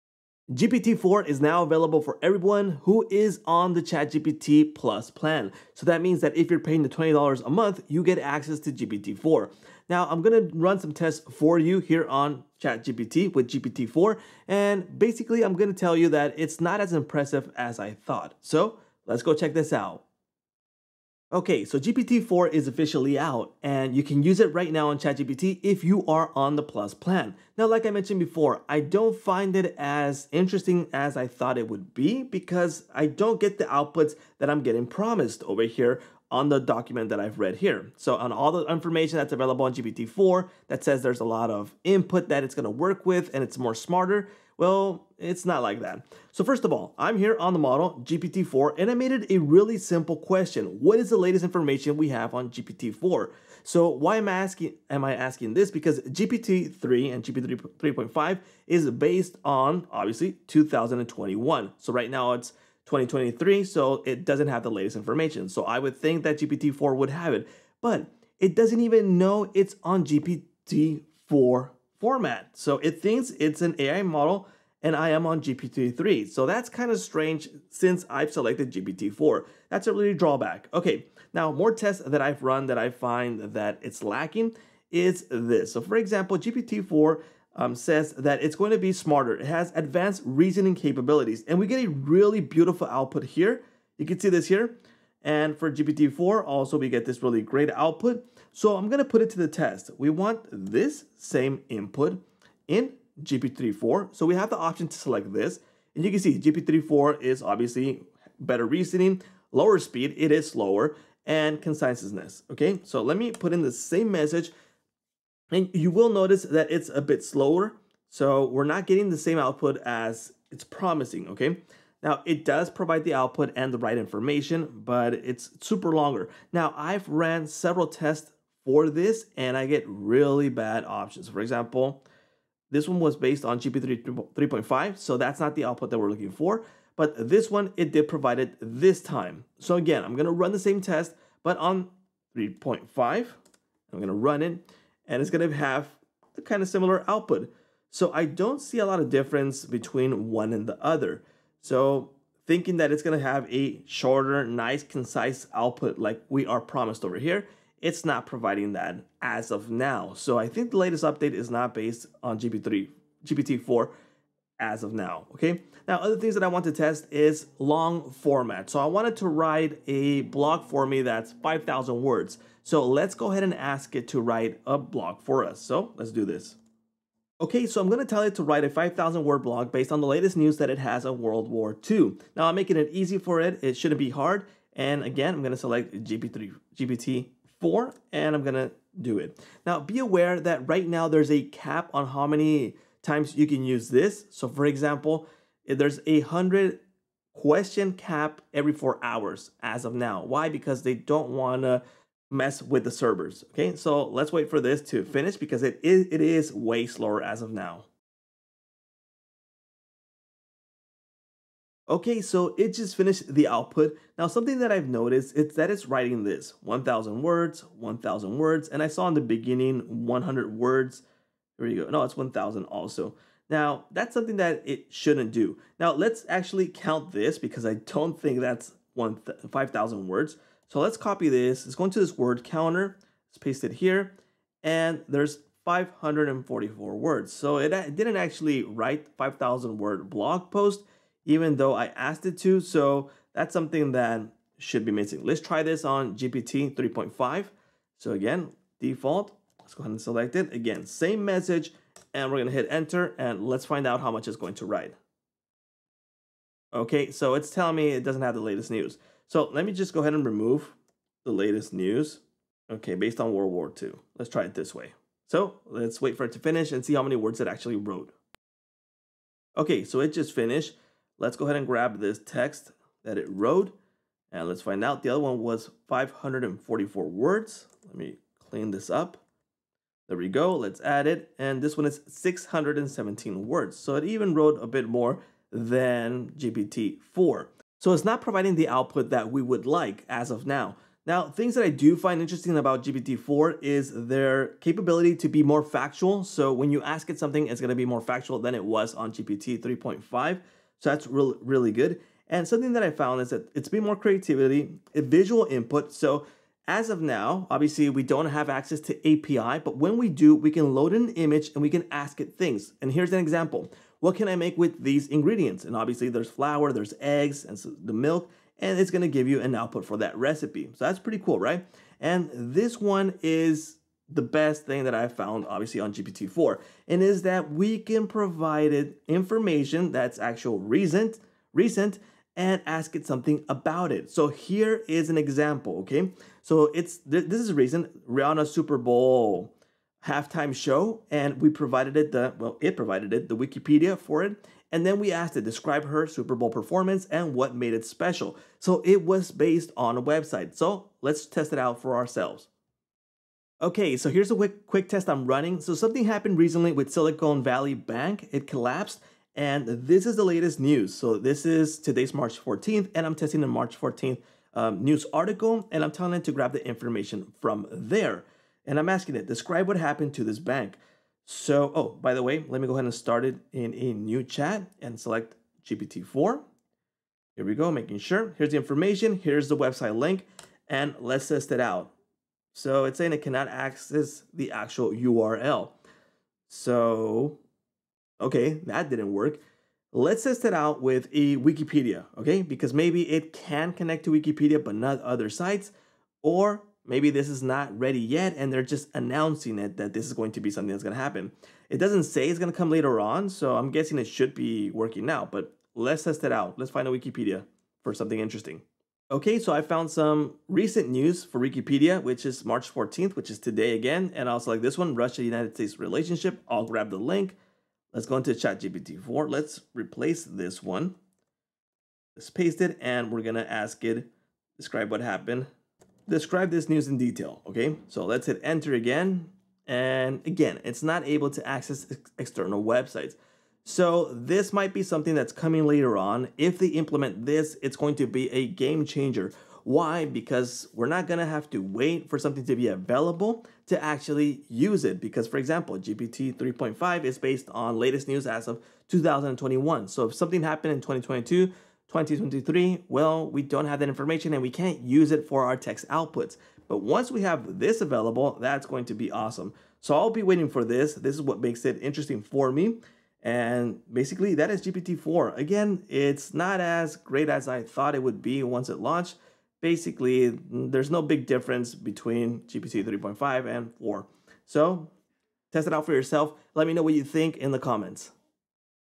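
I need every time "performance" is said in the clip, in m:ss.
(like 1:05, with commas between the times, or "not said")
5:46.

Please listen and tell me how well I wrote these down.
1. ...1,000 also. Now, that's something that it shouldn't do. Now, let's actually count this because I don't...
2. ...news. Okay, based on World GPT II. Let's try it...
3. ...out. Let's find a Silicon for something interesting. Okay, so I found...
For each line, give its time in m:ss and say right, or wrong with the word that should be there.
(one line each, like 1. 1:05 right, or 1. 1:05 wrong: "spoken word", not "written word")
1. 3:42 right
2. 4:21 wrong: "War", not "GPT"
3. 6:46 wrong: "Wikipedia", not "Silicon".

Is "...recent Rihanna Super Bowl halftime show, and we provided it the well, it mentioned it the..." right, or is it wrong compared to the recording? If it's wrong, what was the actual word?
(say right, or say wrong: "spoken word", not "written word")
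wrong: "provided", not "mentioned".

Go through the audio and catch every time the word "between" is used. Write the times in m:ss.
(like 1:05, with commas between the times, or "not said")
2:29, 7:51.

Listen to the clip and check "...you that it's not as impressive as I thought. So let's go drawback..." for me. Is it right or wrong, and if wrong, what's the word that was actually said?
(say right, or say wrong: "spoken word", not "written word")
wrong: "check", not "drawback".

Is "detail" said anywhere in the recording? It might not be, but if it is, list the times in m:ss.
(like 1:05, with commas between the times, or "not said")
7:06.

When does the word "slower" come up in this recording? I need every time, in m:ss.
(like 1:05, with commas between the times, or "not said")
1:50, 1:57, 3:26.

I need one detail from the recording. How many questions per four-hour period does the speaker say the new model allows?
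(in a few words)
100.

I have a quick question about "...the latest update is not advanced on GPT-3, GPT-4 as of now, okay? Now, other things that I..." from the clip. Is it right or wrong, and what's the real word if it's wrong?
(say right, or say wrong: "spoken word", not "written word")
wrong: "based", not "advanced".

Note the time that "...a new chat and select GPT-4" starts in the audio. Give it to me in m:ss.
6:13.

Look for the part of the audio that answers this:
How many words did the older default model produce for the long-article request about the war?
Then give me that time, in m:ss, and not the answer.
4:42.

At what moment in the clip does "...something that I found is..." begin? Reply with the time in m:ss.
5:02.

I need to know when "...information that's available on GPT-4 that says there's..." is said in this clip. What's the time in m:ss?
0:38.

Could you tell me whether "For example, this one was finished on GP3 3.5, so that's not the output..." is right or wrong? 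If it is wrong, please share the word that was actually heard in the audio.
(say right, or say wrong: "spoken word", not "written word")
wrong: "based", not "finished".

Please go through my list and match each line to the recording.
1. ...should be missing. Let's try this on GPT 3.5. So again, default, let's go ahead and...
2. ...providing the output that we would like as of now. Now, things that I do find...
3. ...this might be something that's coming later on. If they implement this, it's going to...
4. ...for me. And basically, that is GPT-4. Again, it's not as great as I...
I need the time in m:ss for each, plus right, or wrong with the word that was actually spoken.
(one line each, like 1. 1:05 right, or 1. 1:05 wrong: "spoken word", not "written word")
1. 4:04 right
2. 4:48 right
3. 7:14 right
4. 7:42 right.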